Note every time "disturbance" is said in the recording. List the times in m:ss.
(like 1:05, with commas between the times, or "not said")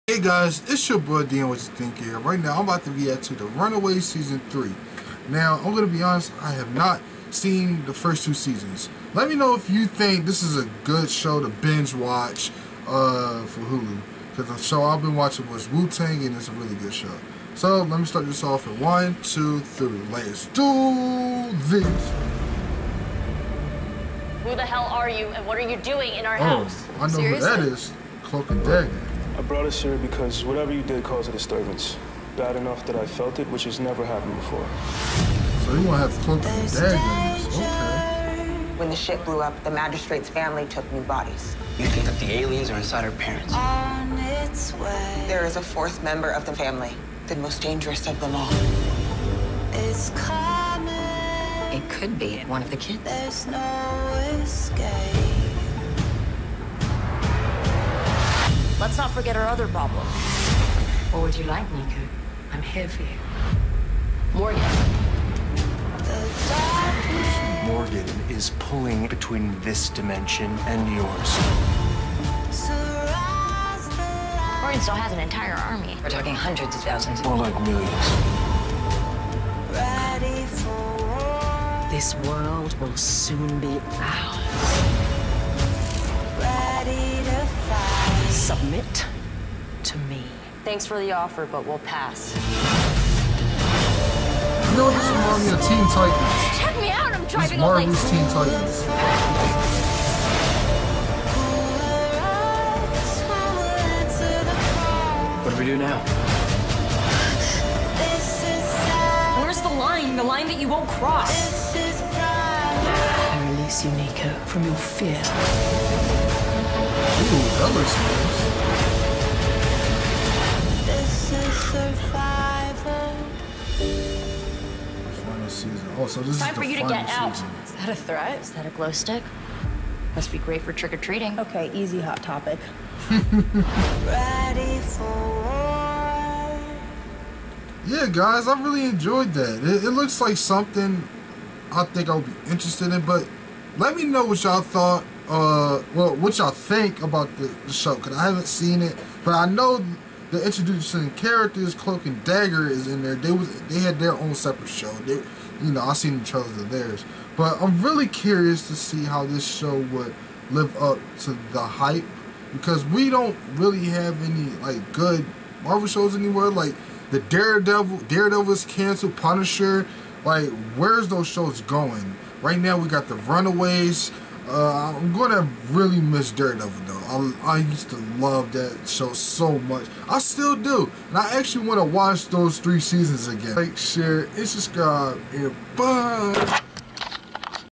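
0:31.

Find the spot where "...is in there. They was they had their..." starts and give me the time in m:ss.
2:32.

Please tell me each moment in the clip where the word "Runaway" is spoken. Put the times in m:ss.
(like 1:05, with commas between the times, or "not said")
0:03, 2:53.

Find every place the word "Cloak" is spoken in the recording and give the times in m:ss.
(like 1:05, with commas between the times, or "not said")
0:28, 2:31.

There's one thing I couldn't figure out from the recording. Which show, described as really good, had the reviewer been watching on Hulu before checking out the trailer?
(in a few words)
Wu-Tang.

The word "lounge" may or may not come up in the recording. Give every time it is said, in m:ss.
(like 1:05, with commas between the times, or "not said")
not said.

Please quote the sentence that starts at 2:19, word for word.
It, it looks like something I think I would be interested in, but let me know what y'all thought.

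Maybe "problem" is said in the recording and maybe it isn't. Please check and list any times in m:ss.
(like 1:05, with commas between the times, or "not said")
0:59.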